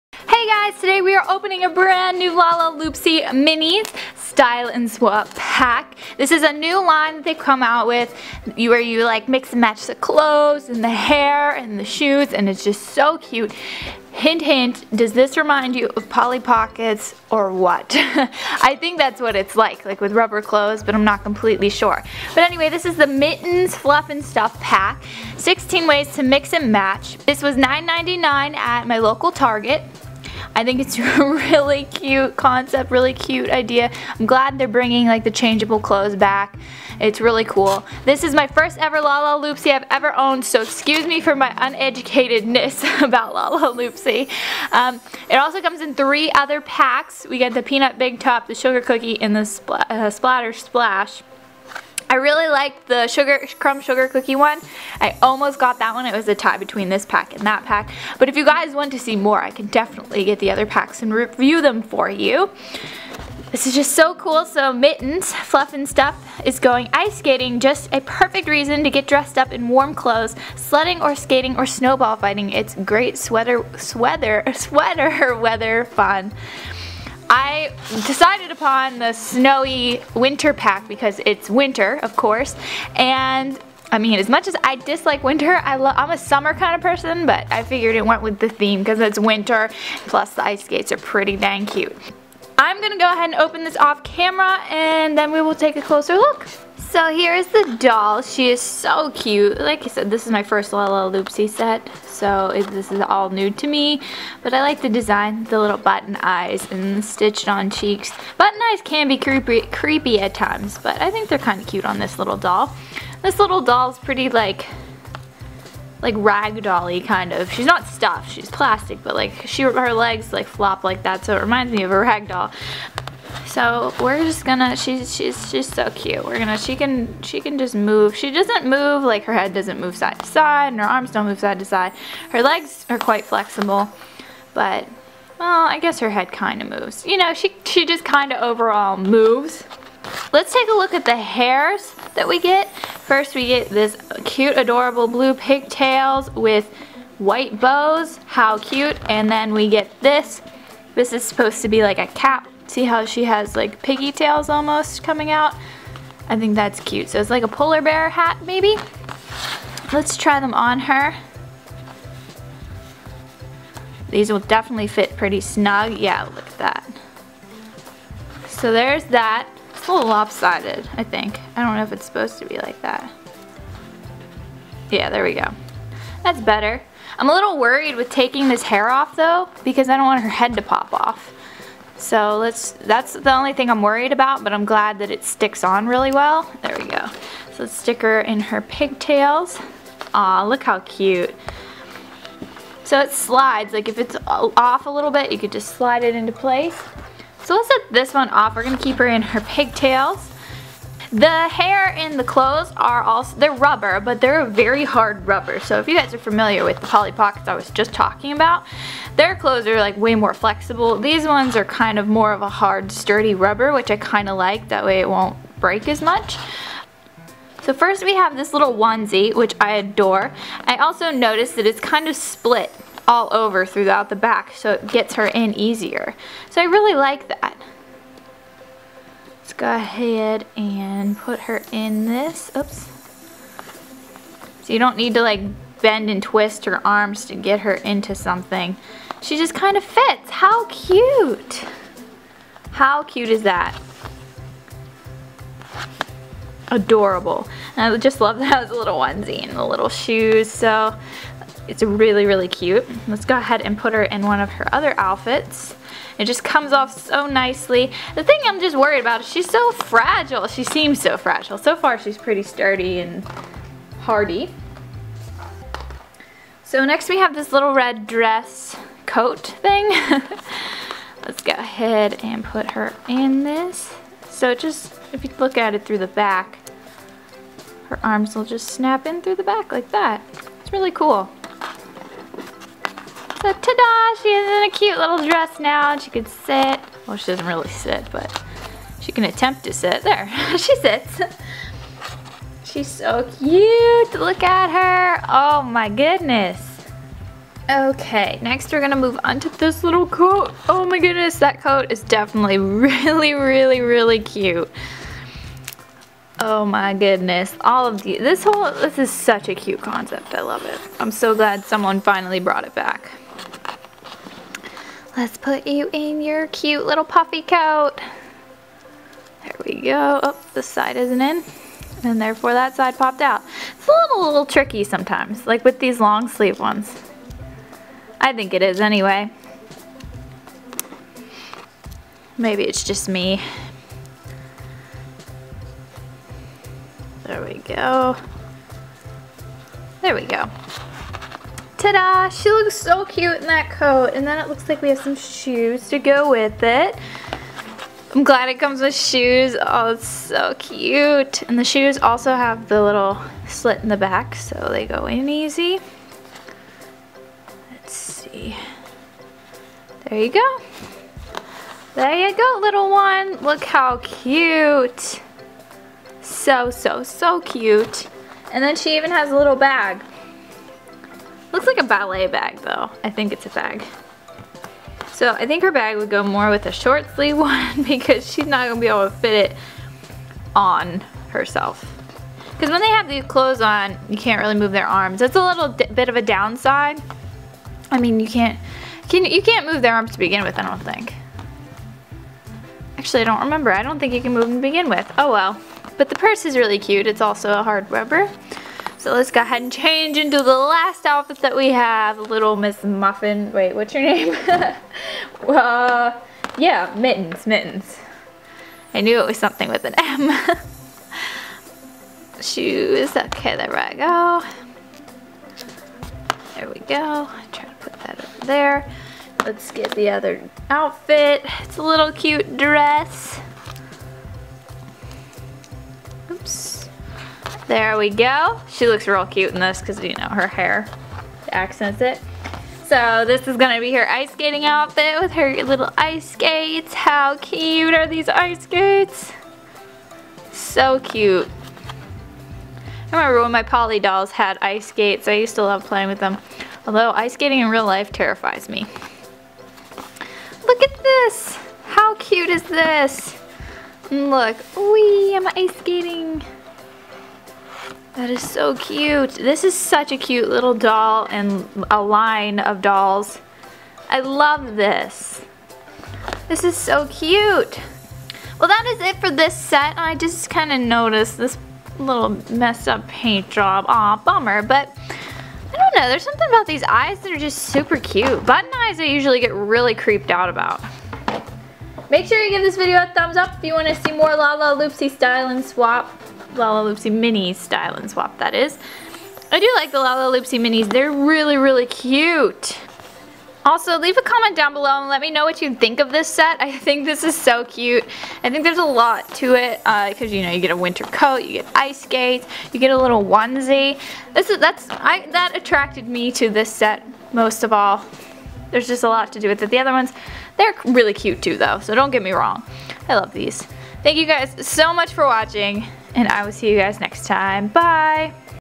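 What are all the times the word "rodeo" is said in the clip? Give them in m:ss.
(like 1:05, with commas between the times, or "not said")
not said.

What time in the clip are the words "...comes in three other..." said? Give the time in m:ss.
0:45.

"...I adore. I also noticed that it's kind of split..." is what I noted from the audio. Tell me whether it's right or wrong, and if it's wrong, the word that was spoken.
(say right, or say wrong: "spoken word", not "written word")
right.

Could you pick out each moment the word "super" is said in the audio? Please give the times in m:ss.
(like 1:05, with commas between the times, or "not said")
7:57.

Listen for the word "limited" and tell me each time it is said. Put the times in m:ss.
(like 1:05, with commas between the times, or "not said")
not said.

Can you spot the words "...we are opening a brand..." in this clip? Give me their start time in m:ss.
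0:01.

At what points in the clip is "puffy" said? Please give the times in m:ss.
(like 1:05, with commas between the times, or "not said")
5:17.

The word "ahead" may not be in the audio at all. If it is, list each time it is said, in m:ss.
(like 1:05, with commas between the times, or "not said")
1:33, 3:49, 4:13, 4:31, 6:39.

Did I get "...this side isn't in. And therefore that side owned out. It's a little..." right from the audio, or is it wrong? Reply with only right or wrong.
wrong.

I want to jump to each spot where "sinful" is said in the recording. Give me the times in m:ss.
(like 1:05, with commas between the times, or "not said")
not said.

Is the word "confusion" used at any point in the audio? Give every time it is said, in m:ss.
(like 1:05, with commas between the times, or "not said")
not said.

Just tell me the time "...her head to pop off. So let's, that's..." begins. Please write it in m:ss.
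3:00.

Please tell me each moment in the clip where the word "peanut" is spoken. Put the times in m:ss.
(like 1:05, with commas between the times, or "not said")
0:47.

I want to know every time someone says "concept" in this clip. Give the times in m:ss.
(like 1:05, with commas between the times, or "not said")
0:32, 5:09.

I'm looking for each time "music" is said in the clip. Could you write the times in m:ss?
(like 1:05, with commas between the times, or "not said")
not said.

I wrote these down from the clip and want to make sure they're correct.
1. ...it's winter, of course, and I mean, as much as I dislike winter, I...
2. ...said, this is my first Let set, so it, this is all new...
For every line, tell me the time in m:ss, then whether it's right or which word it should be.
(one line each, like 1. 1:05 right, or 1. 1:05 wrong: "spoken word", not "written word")
1. 1:21 right
2. 1:39 wrong: "Lalaloopsy", not "Let".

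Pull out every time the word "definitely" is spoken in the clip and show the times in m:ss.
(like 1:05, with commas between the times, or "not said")
0:59, 2:44, 5:02.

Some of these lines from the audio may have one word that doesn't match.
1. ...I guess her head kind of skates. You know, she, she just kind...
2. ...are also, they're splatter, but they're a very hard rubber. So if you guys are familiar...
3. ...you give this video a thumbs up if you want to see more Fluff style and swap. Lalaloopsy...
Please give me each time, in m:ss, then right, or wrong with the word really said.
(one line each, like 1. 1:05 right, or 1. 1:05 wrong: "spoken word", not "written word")
1. 2:15 wrong: "moves", not "skates"
2. 3:22 wrong: "rubber", not "splatter"
3. 8:02 wrong: "Lalaloopsy", not "Fluff".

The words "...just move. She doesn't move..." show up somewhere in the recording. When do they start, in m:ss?
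2:07.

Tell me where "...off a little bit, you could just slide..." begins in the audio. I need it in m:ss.
3:14.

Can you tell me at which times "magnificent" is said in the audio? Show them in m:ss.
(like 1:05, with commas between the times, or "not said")
not said.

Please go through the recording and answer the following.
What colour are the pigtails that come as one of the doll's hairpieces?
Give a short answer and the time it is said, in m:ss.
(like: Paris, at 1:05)
Blue, at 2:25.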